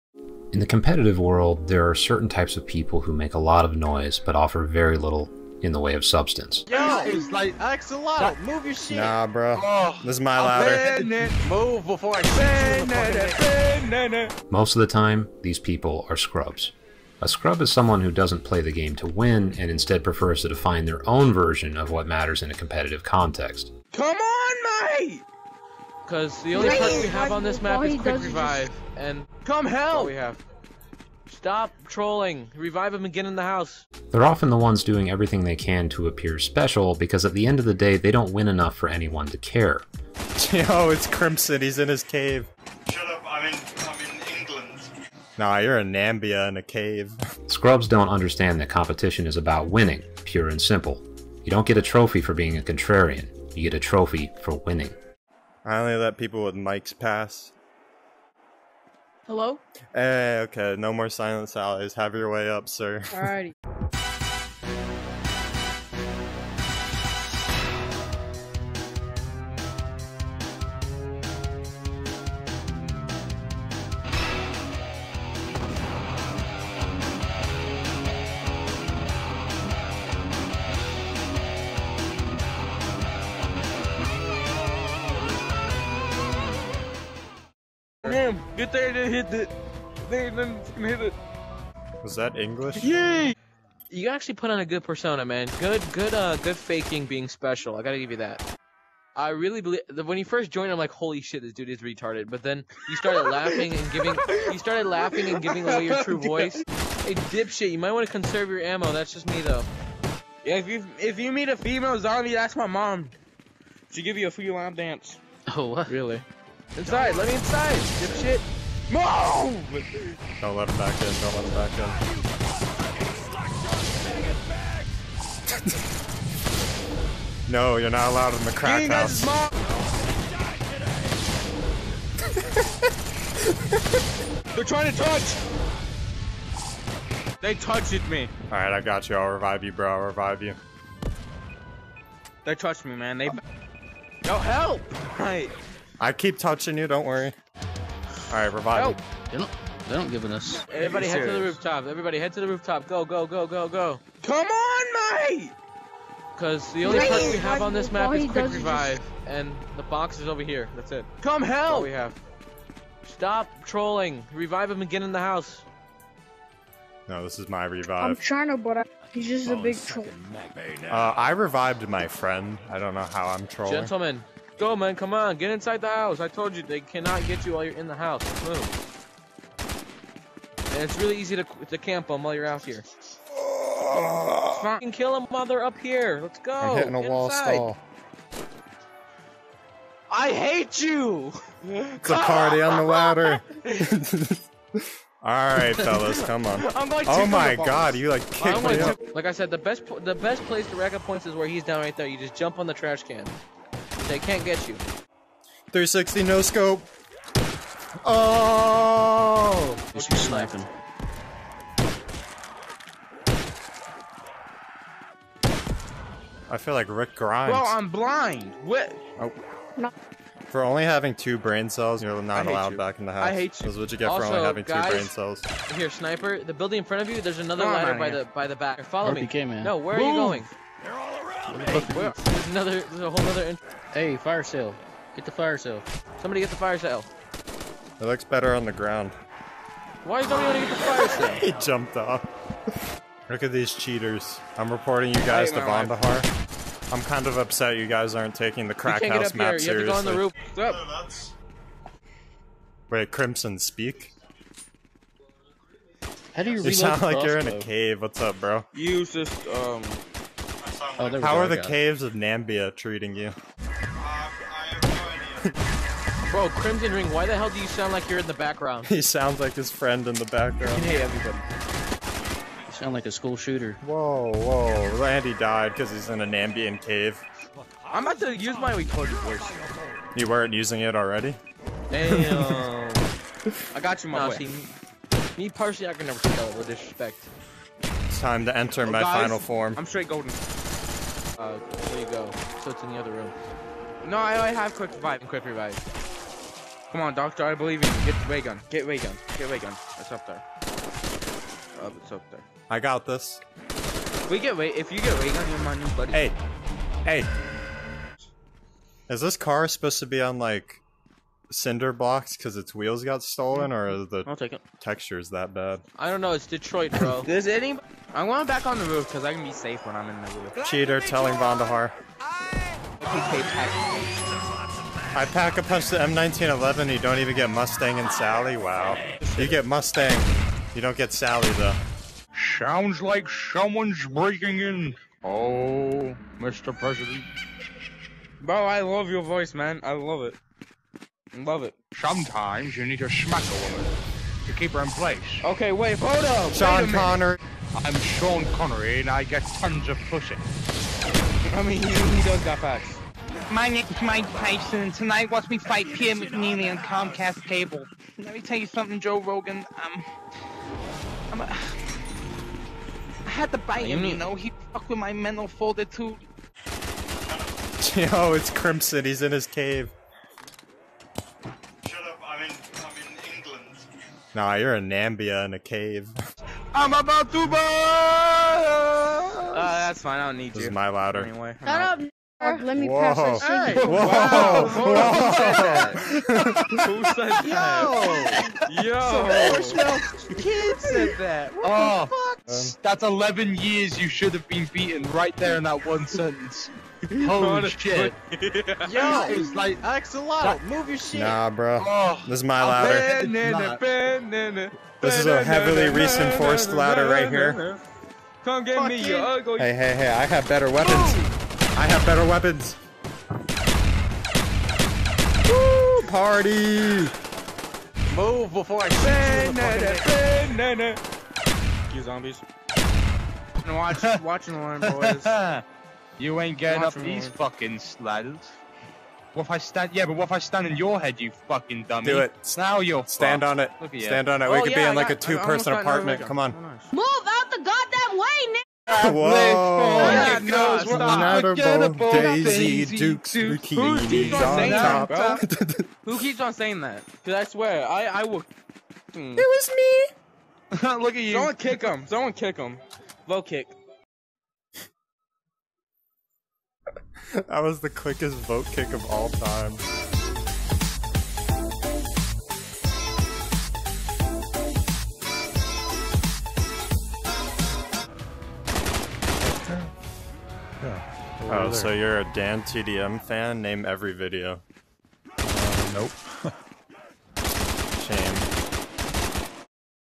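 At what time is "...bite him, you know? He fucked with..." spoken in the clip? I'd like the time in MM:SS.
06:03.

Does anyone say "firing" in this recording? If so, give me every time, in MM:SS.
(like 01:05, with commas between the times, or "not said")
not said.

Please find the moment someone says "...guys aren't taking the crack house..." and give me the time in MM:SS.
04:07.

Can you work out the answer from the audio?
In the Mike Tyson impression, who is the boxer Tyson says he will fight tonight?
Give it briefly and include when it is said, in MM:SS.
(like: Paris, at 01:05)
Pierre McNeeley, at 05:55.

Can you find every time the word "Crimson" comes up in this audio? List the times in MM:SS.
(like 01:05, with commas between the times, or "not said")
00:41, 04:13, 04:26, 06:08.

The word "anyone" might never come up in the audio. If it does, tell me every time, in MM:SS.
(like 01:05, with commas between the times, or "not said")
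00:38.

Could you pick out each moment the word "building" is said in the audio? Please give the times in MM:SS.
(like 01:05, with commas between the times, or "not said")
03:46.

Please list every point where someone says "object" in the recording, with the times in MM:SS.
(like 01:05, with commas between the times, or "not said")
not said.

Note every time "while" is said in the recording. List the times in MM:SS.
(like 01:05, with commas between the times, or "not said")
02:57, 03:02.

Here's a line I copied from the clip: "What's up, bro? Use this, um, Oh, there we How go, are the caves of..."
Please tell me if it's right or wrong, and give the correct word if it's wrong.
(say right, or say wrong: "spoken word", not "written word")
right.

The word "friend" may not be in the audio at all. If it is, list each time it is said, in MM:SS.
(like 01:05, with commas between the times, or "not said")
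02:52, 04:29.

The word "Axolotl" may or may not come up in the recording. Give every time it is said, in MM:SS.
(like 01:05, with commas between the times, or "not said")
00:07, 06:39.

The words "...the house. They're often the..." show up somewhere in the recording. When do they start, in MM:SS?
00:33.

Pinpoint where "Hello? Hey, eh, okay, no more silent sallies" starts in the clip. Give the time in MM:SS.
00:59.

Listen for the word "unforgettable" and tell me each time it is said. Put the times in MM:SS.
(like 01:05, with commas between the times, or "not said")
07:20.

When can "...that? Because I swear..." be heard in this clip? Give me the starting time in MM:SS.
07:26.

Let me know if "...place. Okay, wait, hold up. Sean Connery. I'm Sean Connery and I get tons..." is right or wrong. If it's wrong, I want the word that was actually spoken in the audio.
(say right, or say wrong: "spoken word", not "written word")
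right.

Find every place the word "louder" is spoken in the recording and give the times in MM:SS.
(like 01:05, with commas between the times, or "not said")
00:10, 06:20.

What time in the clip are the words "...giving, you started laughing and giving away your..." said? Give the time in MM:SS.
01:43.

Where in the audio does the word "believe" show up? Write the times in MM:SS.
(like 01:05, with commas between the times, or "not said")
01:39, 04:57.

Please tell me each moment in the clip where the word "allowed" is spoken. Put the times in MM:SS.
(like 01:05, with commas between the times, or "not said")
02:08, 03:42.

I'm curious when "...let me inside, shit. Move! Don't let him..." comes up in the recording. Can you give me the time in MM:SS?
01:57.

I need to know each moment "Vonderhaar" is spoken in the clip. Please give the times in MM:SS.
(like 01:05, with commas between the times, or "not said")
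04:05, 05:21.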